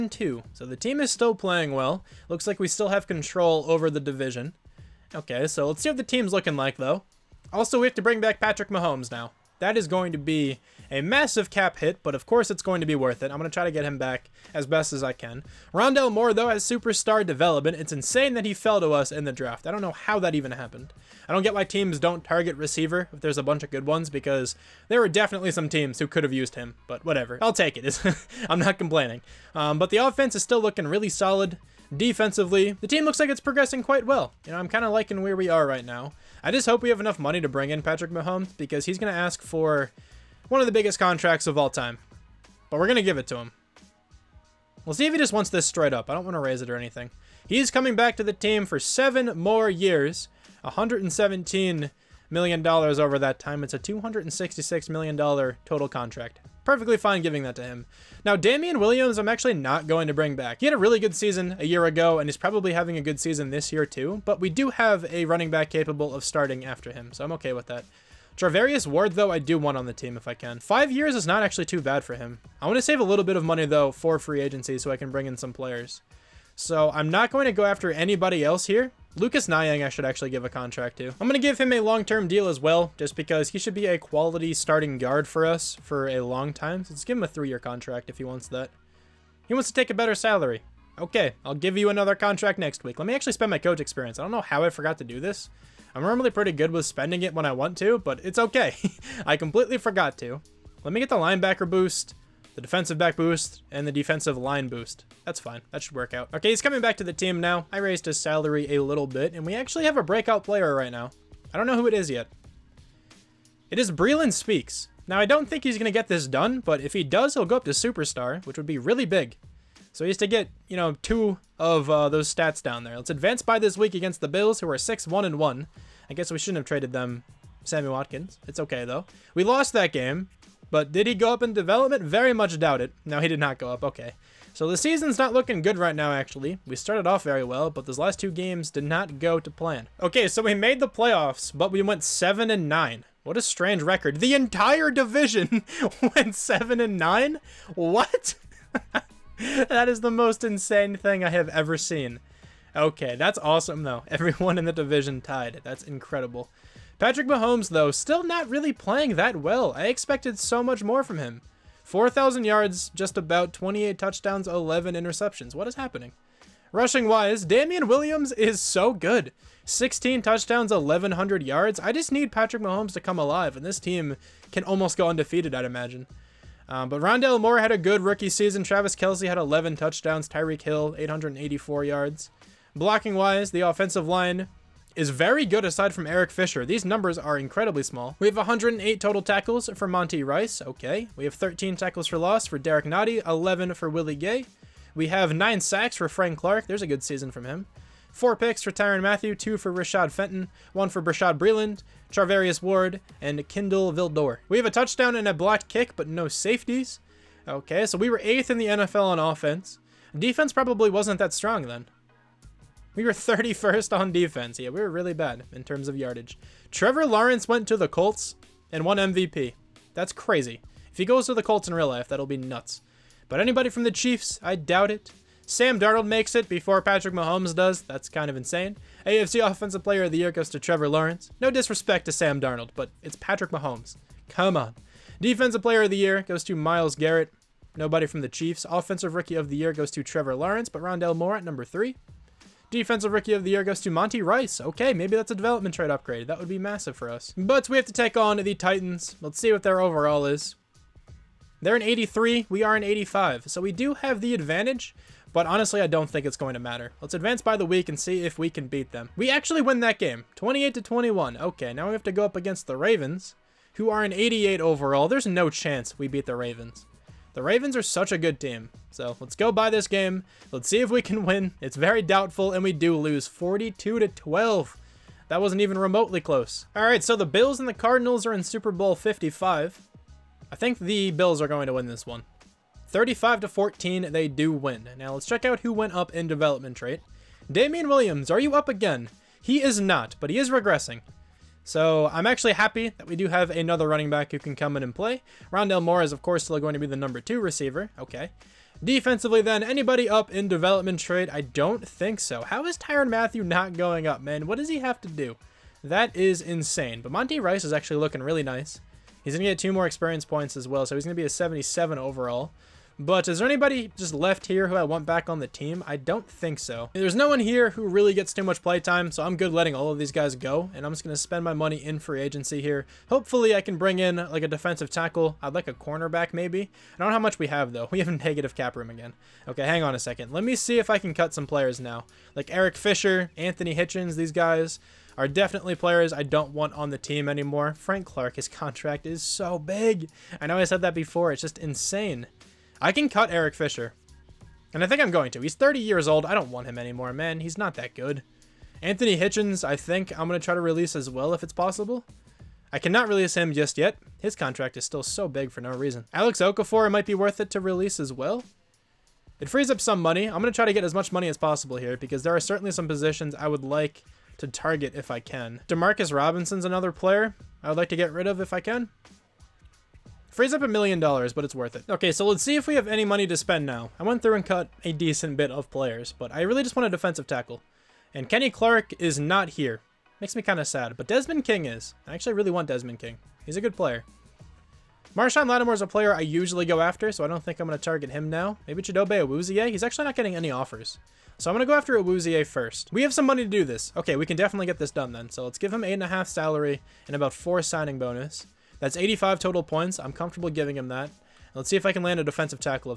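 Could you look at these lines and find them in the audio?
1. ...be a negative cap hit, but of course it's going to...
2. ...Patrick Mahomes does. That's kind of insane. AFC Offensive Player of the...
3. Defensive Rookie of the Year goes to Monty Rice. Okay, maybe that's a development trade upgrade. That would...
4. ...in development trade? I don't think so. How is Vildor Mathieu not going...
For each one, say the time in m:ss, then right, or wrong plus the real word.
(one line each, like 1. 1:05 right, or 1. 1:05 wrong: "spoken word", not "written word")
1. 0:10 wrong: "massive", not "negative"
2. 3:46 right
3. 4:02 right
4. 5:00 wrong: "Tyrann", not "Vildor".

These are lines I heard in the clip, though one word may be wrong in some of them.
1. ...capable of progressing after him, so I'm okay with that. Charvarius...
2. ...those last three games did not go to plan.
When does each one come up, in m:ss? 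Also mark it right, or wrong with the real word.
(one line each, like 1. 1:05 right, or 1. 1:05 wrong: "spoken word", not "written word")
1. 1:05 wrong: "starting", not "progressing"
2. 2:17 wrong: "two", not "three".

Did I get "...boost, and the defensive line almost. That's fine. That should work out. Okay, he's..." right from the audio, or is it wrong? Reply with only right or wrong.
wrong.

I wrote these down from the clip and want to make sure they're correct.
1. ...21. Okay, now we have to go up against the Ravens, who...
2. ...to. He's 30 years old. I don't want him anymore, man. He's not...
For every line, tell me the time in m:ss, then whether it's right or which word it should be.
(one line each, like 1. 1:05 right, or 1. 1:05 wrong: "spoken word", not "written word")
1. 4:20 right
2. 5:45 right.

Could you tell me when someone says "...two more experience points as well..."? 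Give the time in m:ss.
5:09.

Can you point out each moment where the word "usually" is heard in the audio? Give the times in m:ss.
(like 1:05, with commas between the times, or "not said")
6:26.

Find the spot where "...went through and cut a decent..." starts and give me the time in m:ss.
6:14.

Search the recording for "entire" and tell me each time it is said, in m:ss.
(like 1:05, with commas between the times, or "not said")
2:24.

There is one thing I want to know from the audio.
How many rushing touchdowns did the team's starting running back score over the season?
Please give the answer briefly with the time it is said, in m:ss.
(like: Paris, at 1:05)
16, at 2:49.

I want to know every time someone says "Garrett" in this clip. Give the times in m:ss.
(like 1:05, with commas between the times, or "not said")
3:56.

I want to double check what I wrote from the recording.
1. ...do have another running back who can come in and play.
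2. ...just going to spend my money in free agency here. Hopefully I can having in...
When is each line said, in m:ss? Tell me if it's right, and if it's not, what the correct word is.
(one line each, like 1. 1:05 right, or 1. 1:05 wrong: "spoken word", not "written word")
1. 4:53 right
2. 5:20 wrong: "bring", not "having".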